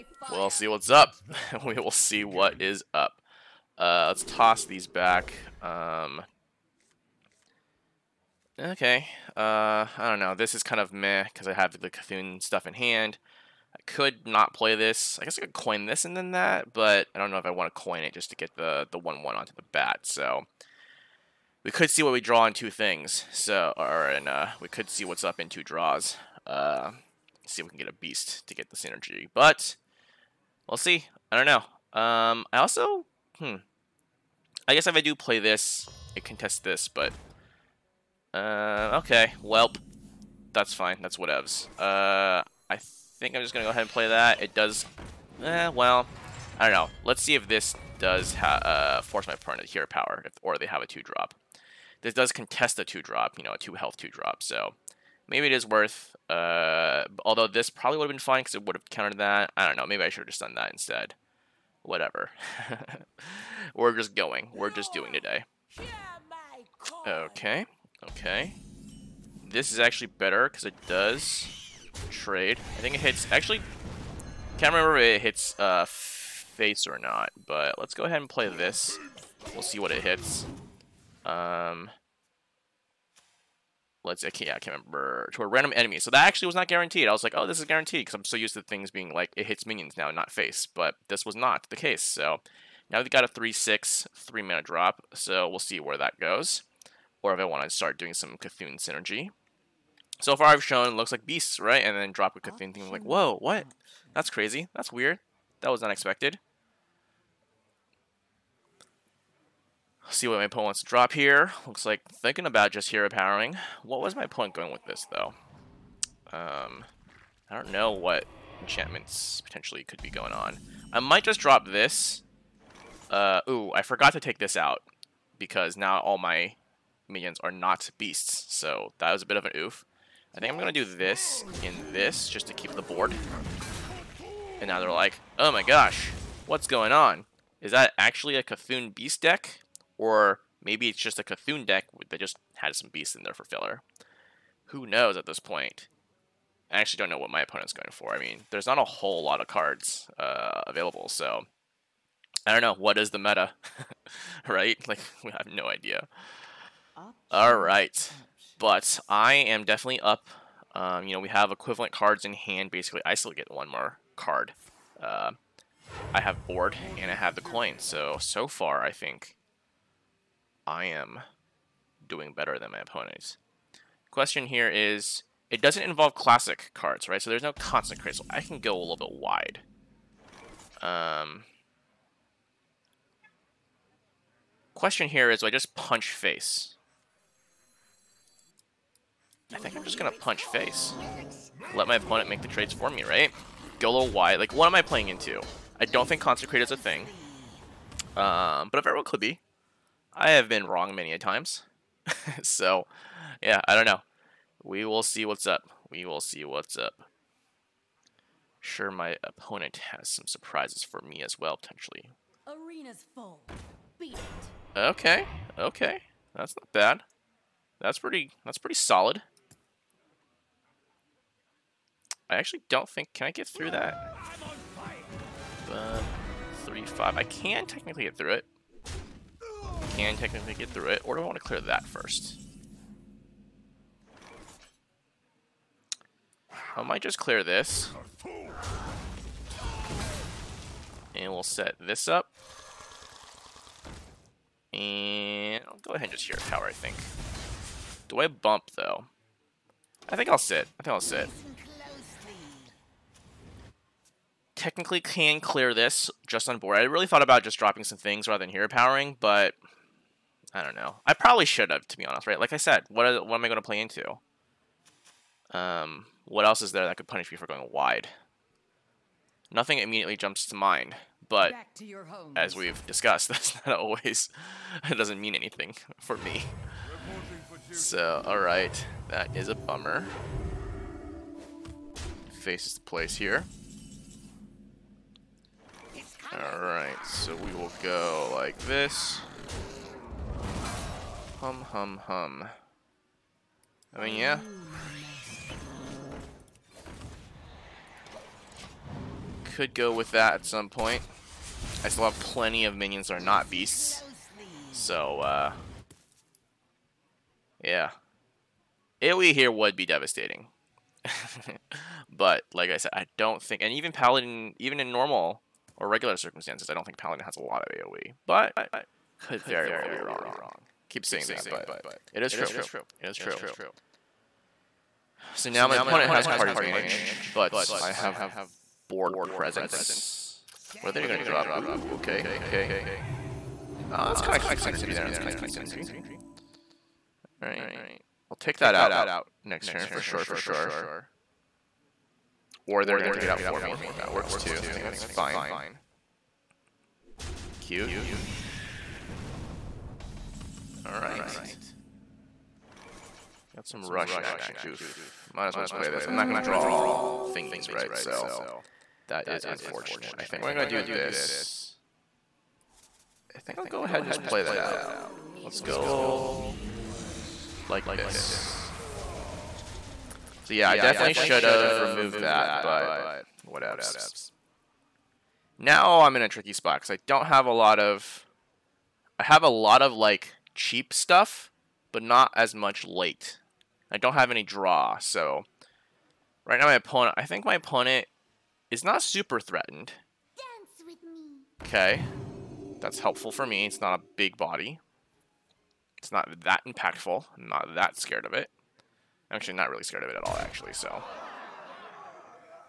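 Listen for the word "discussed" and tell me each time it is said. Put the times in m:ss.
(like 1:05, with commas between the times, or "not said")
4:32.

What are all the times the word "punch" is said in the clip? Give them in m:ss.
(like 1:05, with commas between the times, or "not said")
3:05, 3:10.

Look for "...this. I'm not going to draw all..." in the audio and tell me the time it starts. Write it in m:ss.
5:55.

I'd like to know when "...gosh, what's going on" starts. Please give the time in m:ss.
2:15.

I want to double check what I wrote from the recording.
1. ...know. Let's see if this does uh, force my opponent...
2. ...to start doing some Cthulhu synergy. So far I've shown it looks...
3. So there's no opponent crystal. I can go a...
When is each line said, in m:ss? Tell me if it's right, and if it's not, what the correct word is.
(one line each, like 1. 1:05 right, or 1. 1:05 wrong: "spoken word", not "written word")
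1. 0:46 right
2. 1:37 right
3. 2:57 wrong: "constant", not "opponent".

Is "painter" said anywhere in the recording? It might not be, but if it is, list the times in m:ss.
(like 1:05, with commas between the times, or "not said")
not said.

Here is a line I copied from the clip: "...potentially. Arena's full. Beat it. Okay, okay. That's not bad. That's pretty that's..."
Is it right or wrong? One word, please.
right.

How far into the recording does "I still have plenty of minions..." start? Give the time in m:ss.
5:01.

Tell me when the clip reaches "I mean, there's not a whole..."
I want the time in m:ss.
2:28.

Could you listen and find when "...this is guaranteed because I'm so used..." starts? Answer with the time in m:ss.
1:27.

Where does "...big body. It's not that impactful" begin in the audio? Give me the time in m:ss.
6:34.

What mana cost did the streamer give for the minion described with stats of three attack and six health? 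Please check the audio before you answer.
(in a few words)
3.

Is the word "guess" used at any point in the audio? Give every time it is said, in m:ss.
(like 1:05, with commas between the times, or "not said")
0:15, 0:34.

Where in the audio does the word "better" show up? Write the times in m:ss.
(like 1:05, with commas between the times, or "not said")
1:10, 2:52.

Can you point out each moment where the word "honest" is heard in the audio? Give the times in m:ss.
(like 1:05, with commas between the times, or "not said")
4:22.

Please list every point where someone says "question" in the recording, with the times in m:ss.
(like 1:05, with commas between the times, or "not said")
2:54, 3:04.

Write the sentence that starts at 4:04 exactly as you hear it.
And I'll go ahead and just hear a tower, I think.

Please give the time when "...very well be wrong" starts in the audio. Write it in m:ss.
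5:19.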